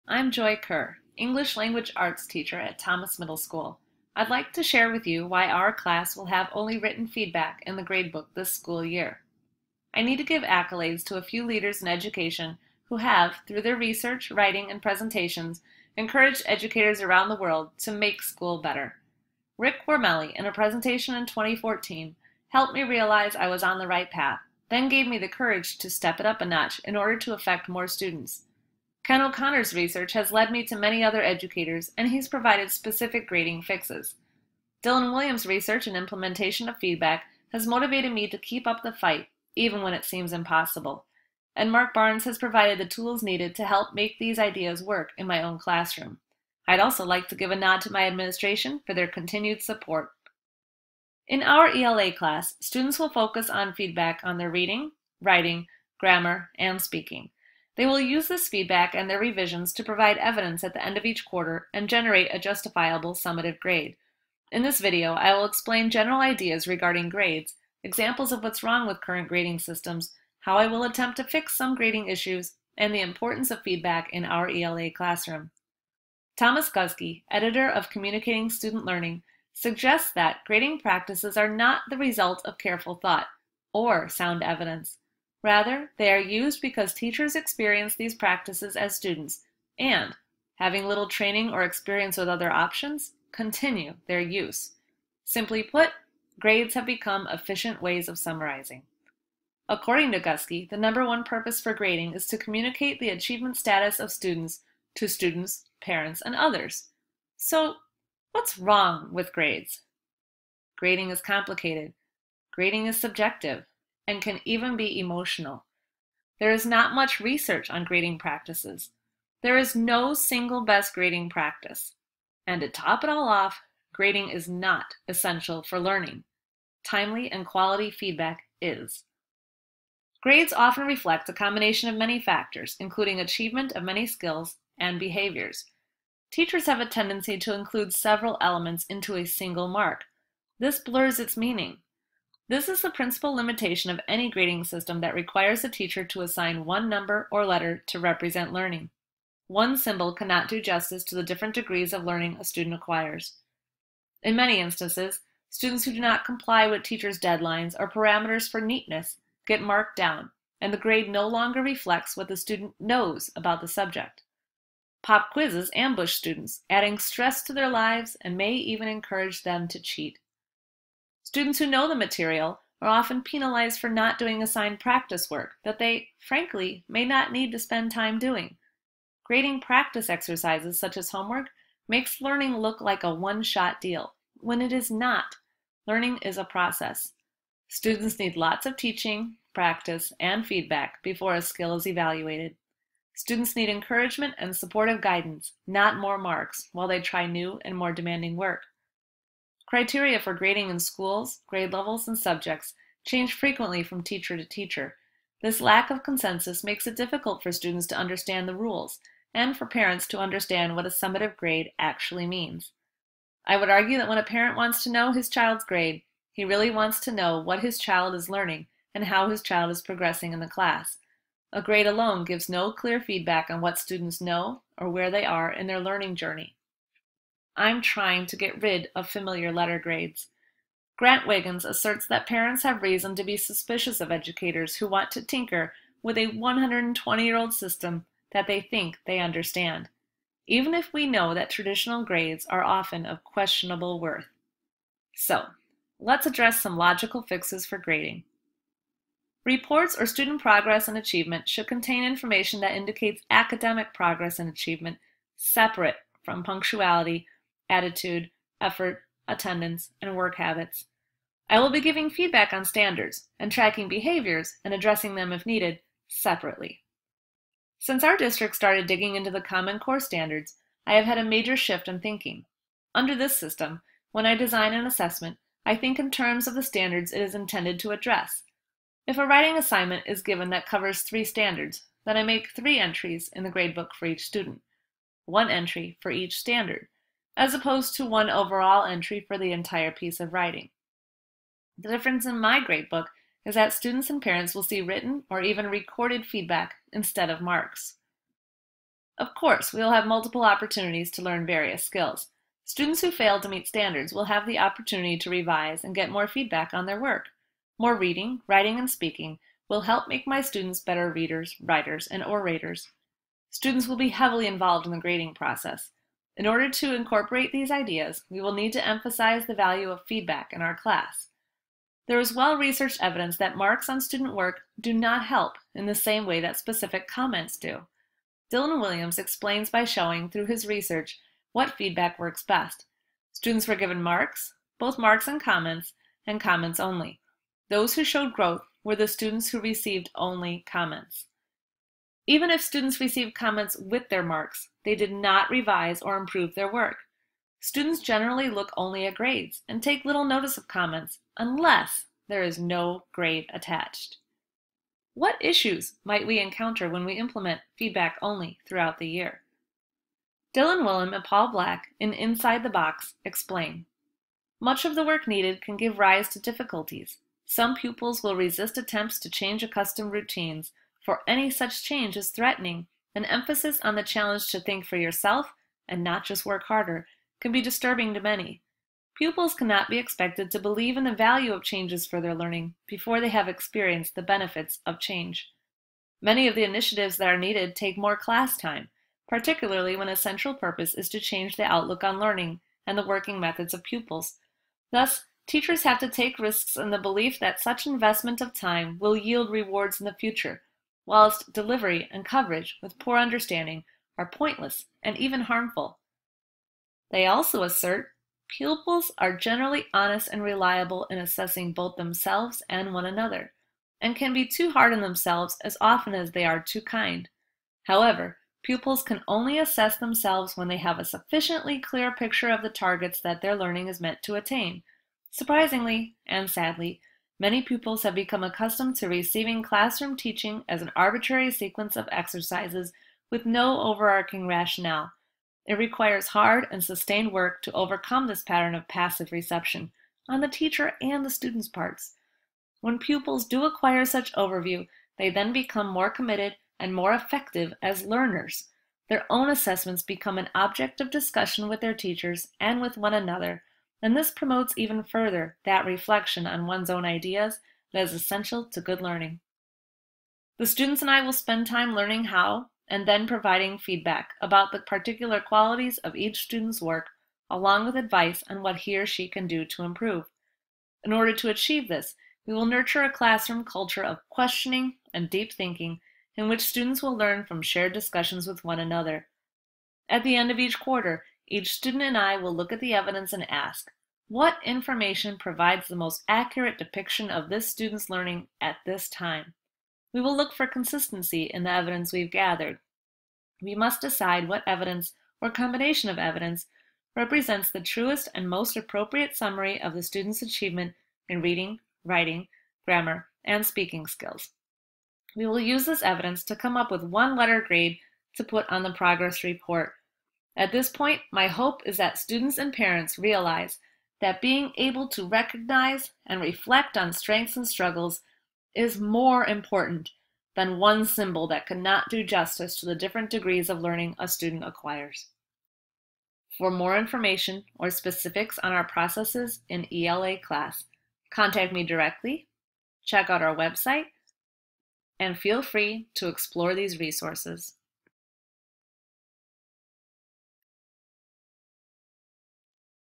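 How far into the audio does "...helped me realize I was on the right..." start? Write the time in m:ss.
0:22.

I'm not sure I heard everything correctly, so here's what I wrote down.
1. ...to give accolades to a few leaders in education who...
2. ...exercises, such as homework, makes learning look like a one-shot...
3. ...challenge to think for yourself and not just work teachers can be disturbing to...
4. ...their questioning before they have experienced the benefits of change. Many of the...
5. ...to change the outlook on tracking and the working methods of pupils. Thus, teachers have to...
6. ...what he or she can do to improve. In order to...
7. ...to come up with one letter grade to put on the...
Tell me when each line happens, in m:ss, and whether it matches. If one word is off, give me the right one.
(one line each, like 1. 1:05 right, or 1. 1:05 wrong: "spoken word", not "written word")
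1. 0:10 right
2. 3:00 right
3. 6:14 wrong: "harder", not "teachers"
4. 6:22 wrong: "learning", not "questioning"
5. 6:31 wrong: "learning", not "tracking"
6. 7:48 right
7. 8:26 right.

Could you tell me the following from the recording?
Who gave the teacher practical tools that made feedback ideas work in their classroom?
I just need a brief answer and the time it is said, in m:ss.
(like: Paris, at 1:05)
Mark Barnes, at 0:41.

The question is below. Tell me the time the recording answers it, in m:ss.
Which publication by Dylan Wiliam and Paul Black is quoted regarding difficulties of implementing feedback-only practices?
6:02.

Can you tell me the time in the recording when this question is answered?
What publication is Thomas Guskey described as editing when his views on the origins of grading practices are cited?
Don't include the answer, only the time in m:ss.
1:17.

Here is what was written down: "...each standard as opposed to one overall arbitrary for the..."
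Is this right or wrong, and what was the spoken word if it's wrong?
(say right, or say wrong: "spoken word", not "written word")
wrong: "entry", not "arbitrary".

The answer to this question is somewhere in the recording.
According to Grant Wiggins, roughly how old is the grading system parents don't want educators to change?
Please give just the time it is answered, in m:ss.
3:56.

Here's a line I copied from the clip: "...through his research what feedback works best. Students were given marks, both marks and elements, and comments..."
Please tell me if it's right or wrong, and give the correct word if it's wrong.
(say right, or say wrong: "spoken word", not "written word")
wrong: "comments", not "elements".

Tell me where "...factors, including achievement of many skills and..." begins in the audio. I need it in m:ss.
2:12.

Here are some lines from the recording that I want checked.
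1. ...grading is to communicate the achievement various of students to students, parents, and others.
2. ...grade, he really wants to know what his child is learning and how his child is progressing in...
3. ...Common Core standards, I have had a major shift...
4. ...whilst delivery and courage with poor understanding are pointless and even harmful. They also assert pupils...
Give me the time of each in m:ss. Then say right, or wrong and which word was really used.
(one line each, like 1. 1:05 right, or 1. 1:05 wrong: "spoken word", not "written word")
1. 1:41 wrong: "status", not "various"
2. 3:35 right
3. 4:29 right
4. 6:41 wrong: "coverage", not "courage".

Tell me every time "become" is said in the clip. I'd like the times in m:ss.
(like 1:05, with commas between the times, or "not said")
1:36, 7:08, 7:25, 7:30.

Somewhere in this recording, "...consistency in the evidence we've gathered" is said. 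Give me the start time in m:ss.
8:10.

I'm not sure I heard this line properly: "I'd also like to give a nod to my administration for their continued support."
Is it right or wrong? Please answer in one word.
right.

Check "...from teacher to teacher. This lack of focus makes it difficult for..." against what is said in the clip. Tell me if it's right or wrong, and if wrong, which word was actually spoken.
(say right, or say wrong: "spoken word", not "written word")
wrong: "consensus", not "focus".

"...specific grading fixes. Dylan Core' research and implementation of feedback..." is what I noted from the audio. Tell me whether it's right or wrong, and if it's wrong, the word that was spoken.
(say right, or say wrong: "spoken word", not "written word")
wrong: "Williams", not "Core".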